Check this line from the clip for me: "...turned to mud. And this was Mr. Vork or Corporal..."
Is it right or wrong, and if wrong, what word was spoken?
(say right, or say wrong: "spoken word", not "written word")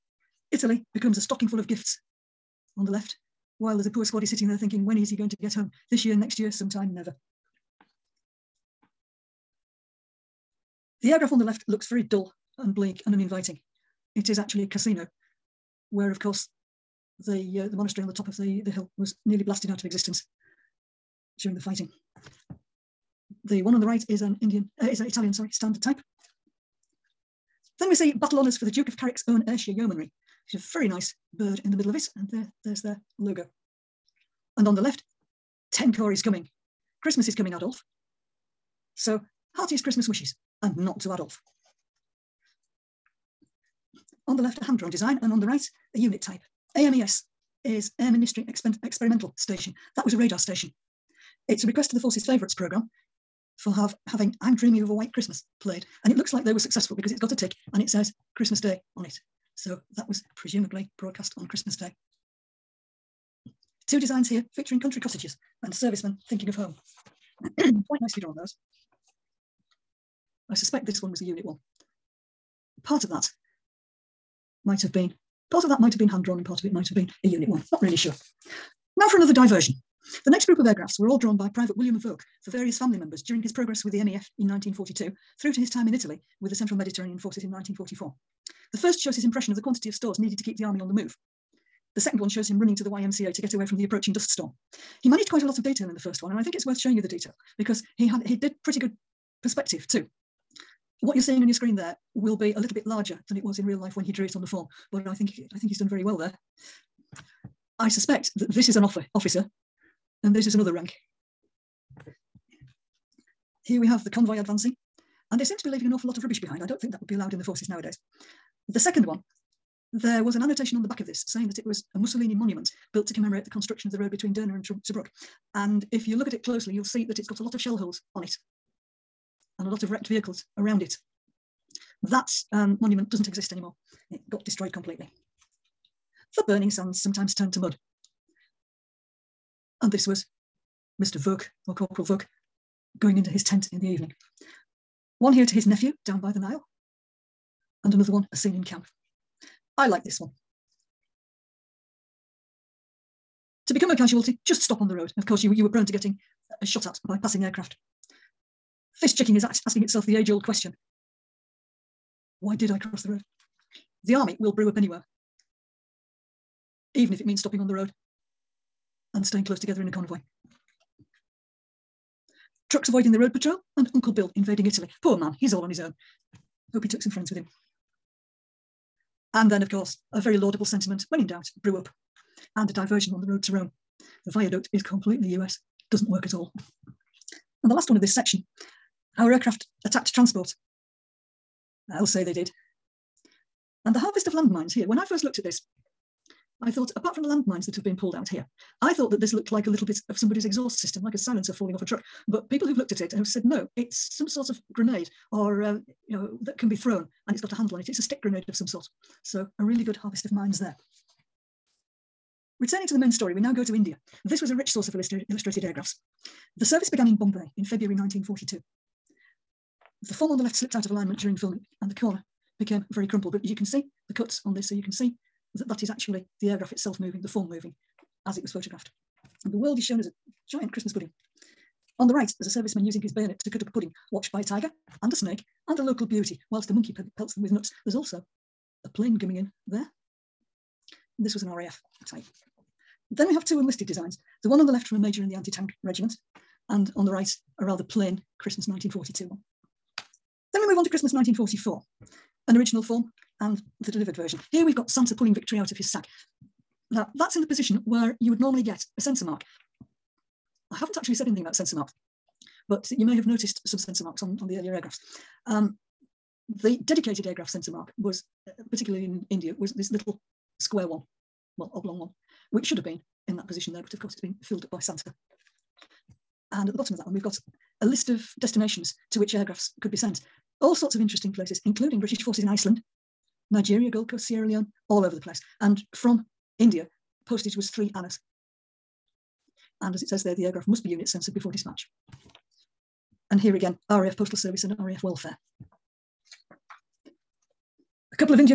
right.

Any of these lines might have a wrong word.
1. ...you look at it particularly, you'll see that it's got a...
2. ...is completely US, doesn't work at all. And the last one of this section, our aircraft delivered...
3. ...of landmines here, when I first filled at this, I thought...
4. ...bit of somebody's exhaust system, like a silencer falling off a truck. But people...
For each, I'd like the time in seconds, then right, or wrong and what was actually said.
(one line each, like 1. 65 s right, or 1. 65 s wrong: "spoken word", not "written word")
1. 126 s wrong: "closely", not "particularly"
2. 184 s wrong: "attacked", not "delivered"
3. 194 s wrong: "looked", not "filled"
4. 199 s right.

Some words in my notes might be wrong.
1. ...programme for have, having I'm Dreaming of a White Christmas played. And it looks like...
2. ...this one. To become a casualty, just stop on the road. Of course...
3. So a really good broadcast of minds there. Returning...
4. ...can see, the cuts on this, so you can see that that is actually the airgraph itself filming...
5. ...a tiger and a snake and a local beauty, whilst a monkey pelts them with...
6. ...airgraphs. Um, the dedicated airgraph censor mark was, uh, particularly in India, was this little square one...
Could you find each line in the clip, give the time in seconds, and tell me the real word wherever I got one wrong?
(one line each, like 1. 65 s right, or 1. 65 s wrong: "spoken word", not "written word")
1. 52 s right
2. 150 s right
3. 209 s wrong: "harvest", not "broadcast"
4. 223 s wrong: "moving", not "filming"
5. 234 s right
6. 264 s right.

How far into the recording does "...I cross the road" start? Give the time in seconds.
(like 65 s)
162 s.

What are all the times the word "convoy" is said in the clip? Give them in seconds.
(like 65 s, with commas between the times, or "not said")
114 s, 169 s.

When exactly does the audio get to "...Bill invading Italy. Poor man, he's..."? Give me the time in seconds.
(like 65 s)
174 s.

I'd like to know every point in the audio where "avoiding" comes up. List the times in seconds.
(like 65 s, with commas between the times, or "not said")
172 s.